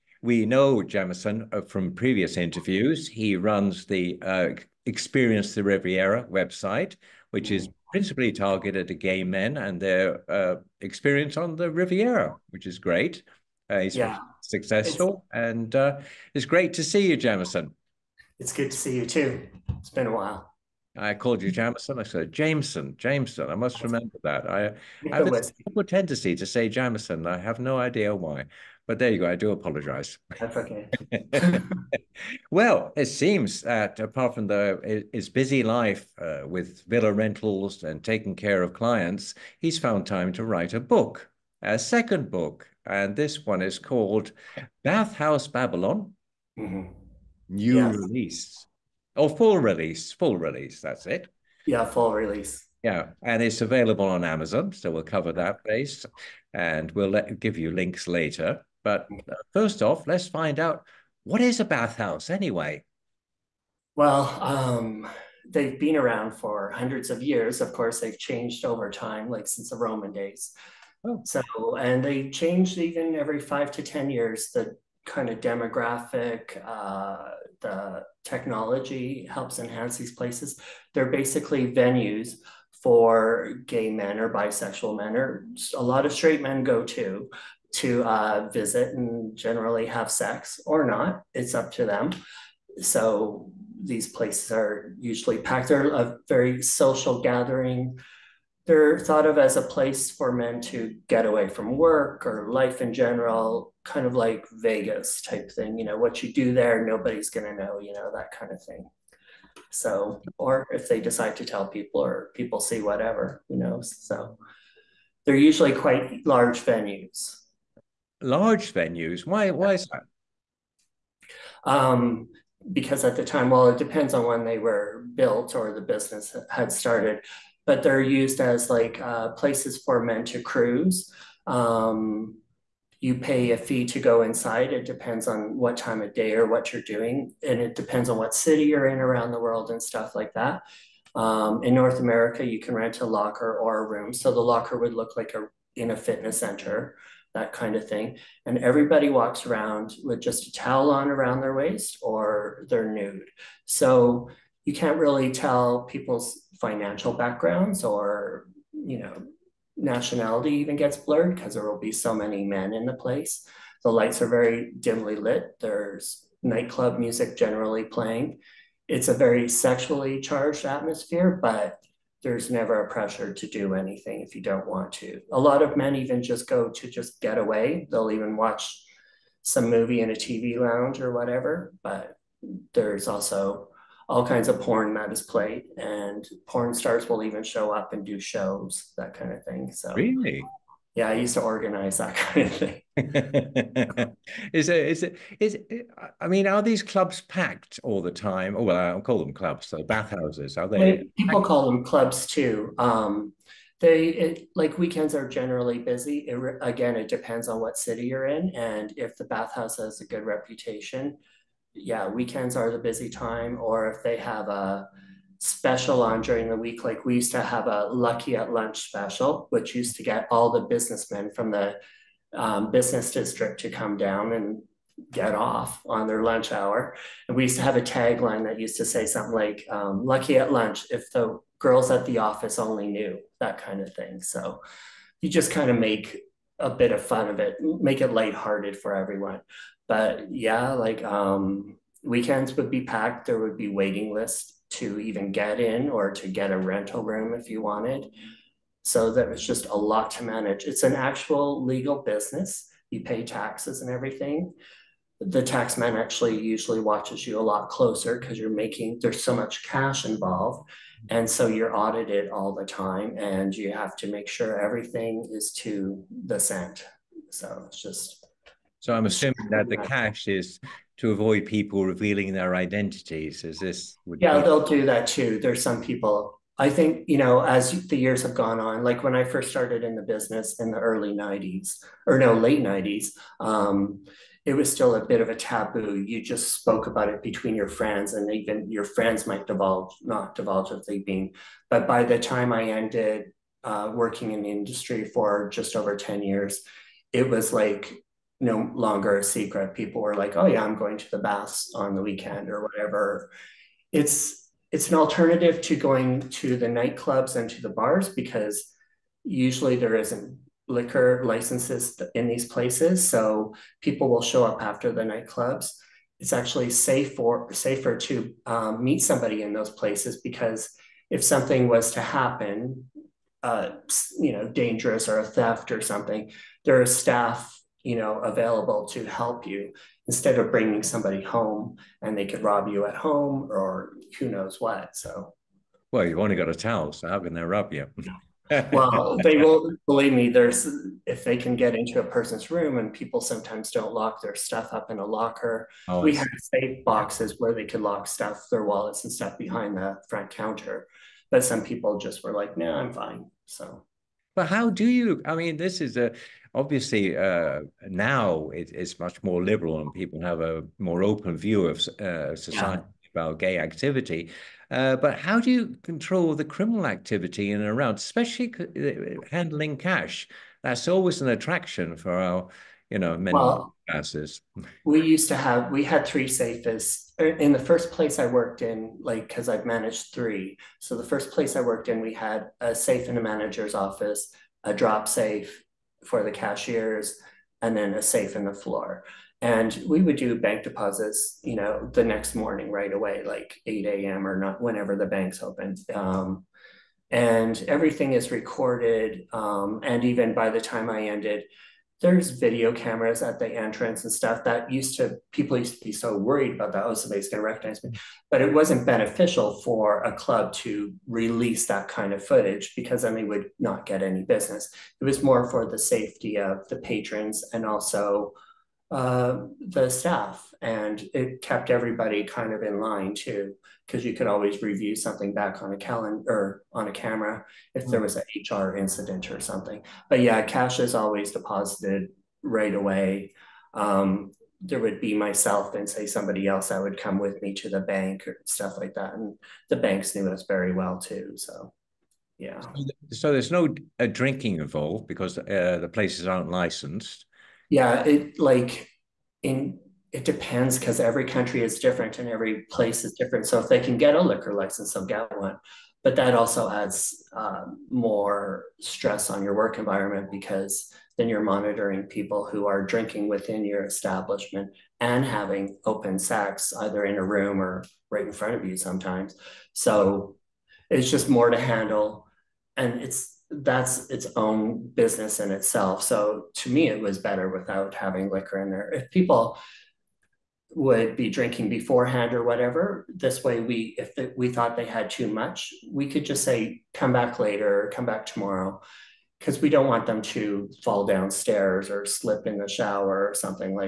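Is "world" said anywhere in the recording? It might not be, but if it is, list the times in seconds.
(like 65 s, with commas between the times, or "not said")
139 s.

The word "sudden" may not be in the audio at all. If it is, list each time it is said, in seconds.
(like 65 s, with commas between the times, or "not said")
not said.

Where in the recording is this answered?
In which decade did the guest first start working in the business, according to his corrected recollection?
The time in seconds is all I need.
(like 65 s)
282 s.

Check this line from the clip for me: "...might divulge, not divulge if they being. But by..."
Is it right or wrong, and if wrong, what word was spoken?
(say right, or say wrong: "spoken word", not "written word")
right.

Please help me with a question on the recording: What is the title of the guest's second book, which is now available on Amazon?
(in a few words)
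Bathhouse Babylon.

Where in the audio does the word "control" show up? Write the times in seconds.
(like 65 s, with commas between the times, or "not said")
365 s.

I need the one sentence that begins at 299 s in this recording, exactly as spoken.
People were like, oh, yeah, I'm going to the baths on the weekend or whatever.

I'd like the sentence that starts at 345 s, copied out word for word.
Oh, we had safe boxes where they could lock stuff, their wallets and stuff behind the front counter.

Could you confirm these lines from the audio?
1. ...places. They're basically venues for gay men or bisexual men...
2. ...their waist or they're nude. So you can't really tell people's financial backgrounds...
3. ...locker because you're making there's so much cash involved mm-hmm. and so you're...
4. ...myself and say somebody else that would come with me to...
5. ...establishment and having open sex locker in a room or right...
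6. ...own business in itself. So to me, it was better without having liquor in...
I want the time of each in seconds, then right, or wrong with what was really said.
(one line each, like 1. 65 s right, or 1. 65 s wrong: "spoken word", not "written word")
1. 80 s right
2. 151 s right
3. 257 s wrong: "closer", not "locker"
4. 435 s right
5. 463 s wrong: "either", not "locker"
6. 474 s right.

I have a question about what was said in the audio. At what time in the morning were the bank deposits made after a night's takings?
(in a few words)
8 a.m.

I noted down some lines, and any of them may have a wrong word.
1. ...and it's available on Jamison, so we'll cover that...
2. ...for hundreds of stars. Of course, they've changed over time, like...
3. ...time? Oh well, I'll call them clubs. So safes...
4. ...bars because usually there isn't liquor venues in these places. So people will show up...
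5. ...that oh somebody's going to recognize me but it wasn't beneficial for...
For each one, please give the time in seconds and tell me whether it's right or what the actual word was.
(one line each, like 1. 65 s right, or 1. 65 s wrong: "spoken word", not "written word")
1. 53 s wrong: "Amazon", not "Jamison"
2. 66 s wrong: "years", not "stars"
3. 198 s wrong: "bathhouses", not "safes"
4. 307 s wrong: "licenses", not "venues"
5. 406 s right.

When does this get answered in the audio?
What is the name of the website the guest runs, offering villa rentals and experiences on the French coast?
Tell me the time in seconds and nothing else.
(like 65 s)
4 s.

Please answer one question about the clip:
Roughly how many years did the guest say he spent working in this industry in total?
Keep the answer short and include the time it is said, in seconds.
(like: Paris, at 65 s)
Just over 10 years, at 295 s.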